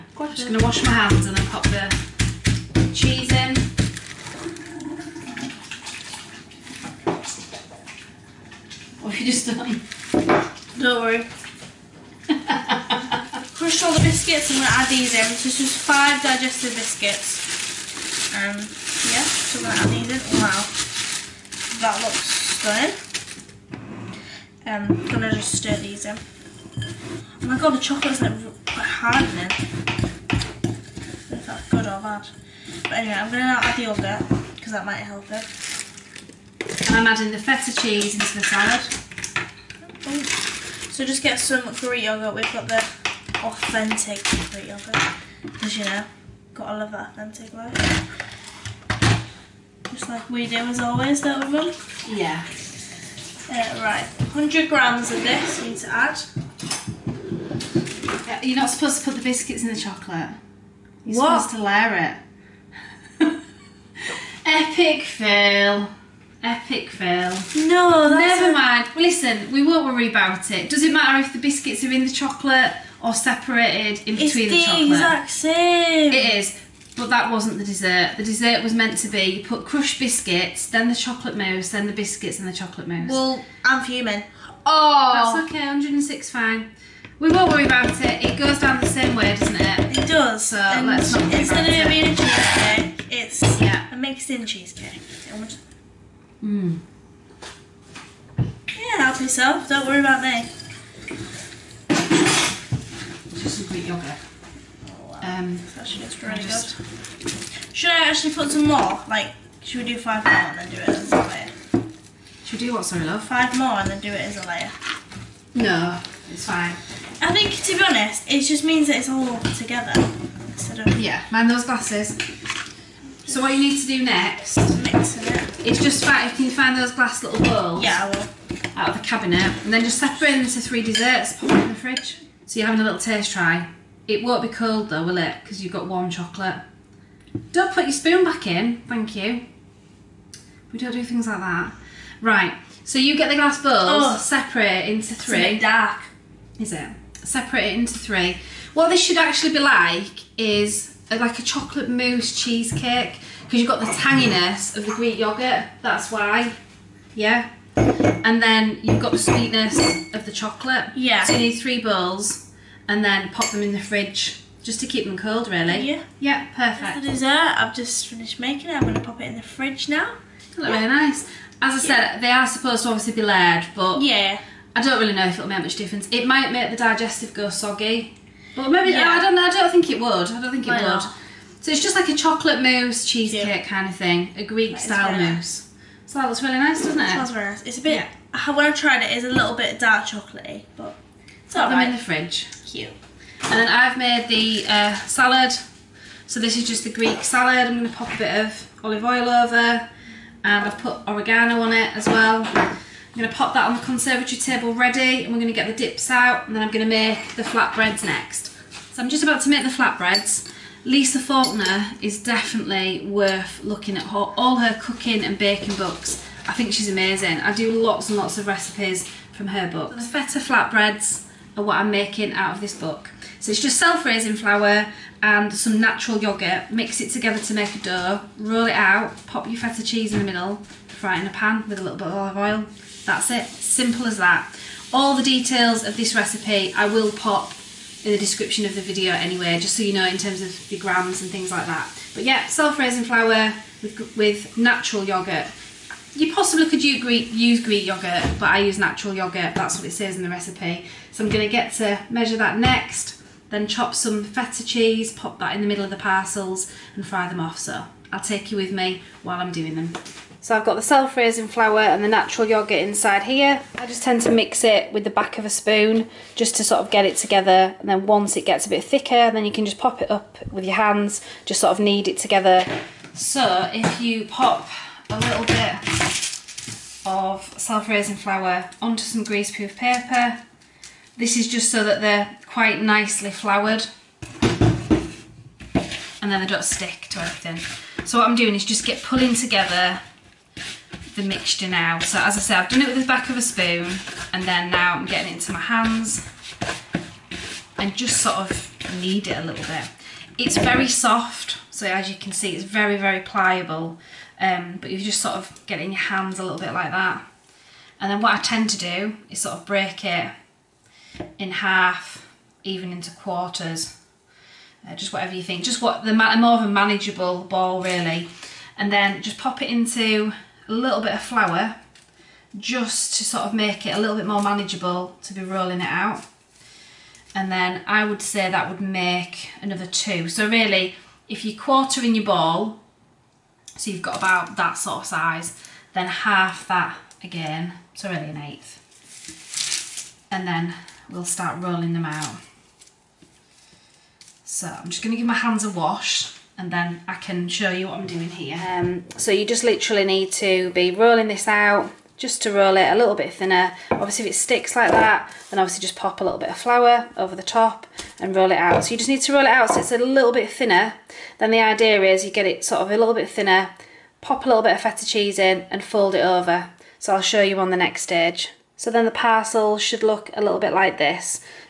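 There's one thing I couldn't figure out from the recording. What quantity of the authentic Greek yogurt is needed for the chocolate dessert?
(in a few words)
100 grams.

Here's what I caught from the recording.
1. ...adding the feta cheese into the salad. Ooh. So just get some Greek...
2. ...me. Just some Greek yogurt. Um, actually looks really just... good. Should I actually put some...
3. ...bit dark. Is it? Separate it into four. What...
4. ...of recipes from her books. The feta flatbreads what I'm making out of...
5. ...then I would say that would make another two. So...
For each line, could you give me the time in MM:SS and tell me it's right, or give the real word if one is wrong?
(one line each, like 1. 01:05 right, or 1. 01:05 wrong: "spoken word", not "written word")
1. 00:37 right
2. 01:40 right
3. 02:25 wrong: "three", not "four"
4. 03:38 right
5. 05:27 right.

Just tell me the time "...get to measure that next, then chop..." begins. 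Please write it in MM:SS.
04:11.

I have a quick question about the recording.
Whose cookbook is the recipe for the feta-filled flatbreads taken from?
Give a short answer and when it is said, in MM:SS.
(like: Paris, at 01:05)
Lisa Faulkner, at 03:30.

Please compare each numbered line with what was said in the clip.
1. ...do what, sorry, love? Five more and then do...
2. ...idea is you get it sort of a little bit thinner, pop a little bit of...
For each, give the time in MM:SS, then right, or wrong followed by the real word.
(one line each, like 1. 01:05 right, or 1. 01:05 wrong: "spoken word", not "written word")
1. 01:52 right
2. 06:01 right.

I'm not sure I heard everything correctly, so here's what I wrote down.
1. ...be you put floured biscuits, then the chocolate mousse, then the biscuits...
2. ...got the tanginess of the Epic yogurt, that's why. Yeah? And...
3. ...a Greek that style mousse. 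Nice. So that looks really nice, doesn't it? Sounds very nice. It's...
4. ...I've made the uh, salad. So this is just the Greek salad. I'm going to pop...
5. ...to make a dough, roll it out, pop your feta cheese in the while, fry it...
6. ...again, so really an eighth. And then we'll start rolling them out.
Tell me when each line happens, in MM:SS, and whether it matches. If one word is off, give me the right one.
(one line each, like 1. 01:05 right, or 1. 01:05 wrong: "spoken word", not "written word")
1. 01:19 wrong: "crushed", not "floured"
2. 02:33 wrong: "Greek", not "Epic"
3. 03:04 right
4. 03:13 right
5. 03:47 wrong: "middle", not "while"
6. 05:37 right.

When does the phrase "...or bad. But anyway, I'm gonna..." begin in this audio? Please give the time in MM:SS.
00:31.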